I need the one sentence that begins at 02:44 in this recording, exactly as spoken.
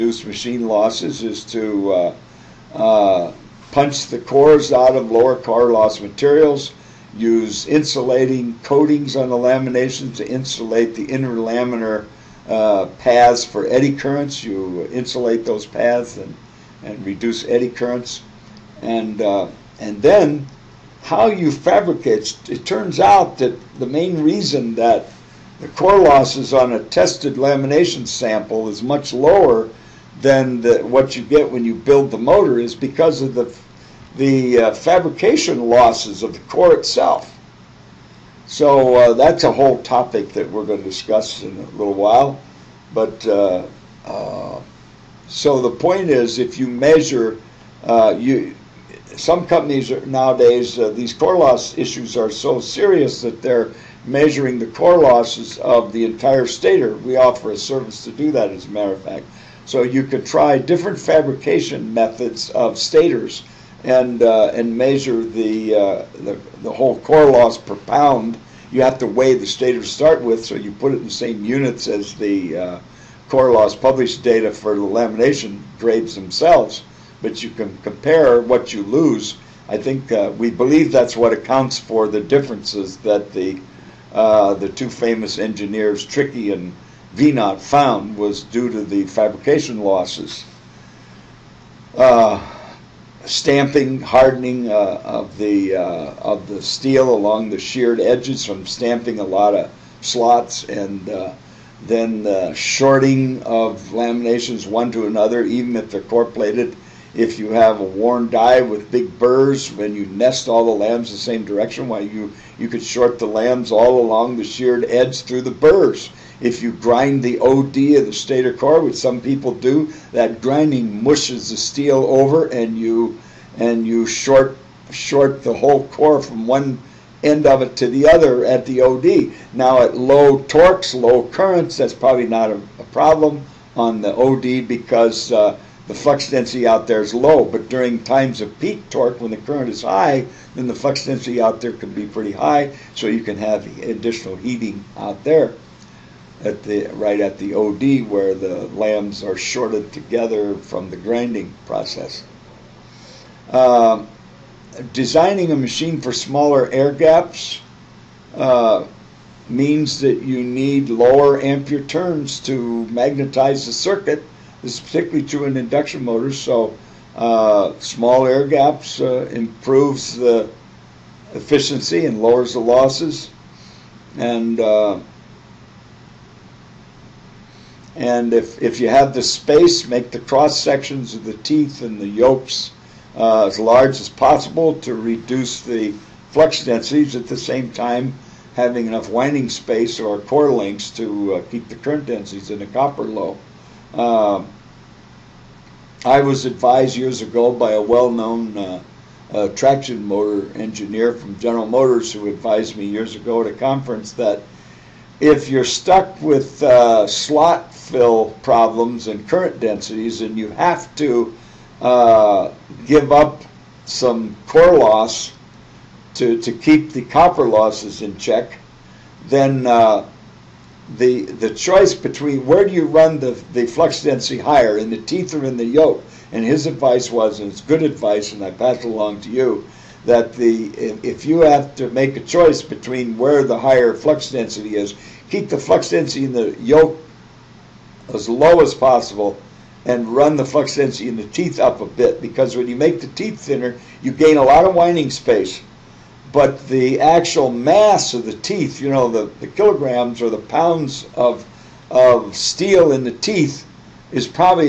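This is particularly true in induction motors, so uh, small air gaps uh, improves the efficiency and lowers the losses.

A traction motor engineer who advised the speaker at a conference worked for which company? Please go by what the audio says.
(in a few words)
General Motors.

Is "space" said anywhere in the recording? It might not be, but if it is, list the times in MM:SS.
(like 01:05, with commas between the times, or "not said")
02:59, 03:09, 04:05.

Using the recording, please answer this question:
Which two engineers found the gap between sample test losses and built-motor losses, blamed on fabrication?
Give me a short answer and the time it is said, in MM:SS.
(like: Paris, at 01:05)
Trickey and Veinott, at 01:26.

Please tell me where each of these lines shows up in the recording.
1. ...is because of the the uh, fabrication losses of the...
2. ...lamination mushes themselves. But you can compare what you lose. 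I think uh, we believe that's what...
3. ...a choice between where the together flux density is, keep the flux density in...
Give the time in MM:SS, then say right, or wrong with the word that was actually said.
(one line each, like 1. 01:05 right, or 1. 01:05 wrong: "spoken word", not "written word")
1. 00:32 right
2. 01:14 wrong: "grades", not "mushes"
3. 03:52 wrong: "higher", not "together".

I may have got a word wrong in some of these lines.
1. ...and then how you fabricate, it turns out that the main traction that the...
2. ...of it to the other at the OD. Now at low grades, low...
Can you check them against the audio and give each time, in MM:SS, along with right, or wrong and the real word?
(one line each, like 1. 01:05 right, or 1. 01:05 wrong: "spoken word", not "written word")
1. 00:19 wrong: "reason", not "traction"
2. 02:07 wrong: "torques", not "grades".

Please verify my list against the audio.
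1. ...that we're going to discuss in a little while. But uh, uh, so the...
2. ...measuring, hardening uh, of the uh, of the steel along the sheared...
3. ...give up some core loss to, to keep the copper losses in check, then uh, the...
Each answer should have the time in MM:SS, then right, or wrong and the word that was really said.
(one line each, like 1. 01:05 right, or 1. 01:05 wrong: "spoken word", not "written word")
1. 00:40 right
2. 01:33 wrong: "stamping", not "measuring"
3. 03:32 right.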